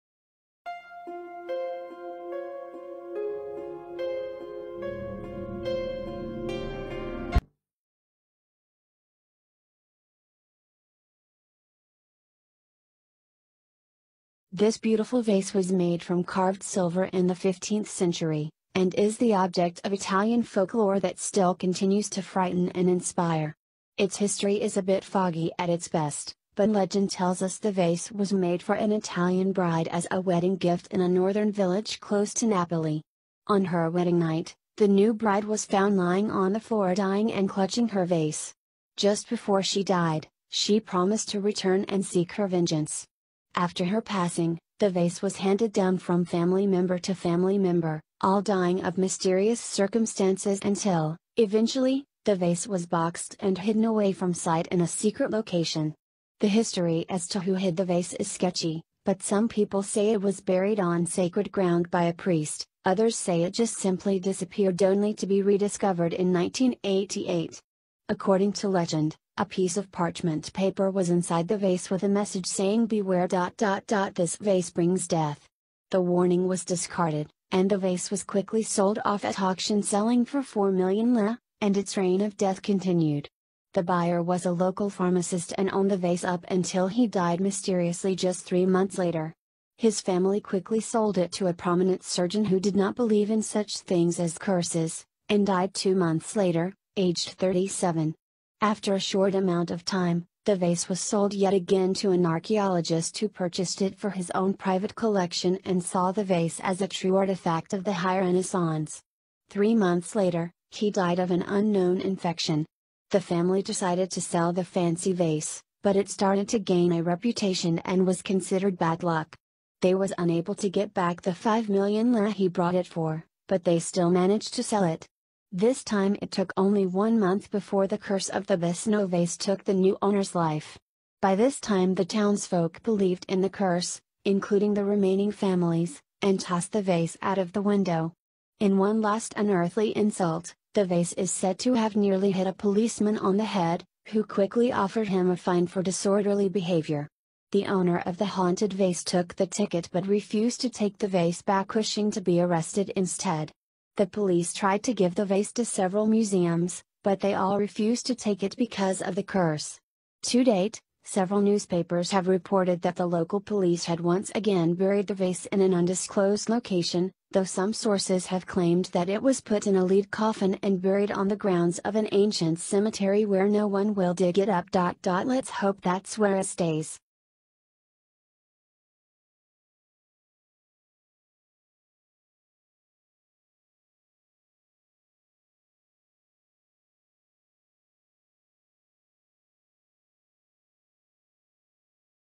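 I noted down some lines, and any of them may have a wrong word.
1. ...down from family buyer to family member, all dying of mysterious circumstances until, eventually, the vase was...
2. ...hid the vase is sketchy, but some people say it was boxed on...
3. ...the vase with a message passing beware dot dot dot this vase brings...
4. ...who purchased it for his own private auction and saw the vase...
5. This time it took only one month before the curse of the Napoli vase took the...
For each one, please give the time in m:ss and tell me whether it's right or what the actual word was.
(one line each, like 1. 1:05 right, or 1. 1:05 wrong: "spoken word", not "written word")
1. 0:45 wrong: "member", not "buyer"
2. 0:57 wrong: "buried", not "boxed"
3. 1:11 wrong: "saying", not "passing"
4. 1:43 wrong: "collection", not "auction"
5. 2:05 wrong: "Basano", not "Napoli".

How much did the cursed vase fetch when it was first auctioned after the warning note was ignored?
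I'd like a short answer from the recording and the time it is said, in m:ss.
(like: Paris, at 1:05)
4 million lira, at 1:20.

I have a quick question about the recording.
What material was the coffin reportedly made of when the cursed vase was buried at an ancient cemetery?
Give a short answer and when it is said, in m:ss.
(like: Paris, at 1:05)
Lead, at 2:49.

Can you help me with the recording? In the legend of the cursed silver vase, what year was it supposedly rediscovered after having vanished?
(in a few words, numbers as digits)
1988.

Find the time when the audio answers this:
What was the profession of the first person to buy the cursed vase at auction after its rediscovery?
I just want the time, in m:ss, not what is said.
1:24.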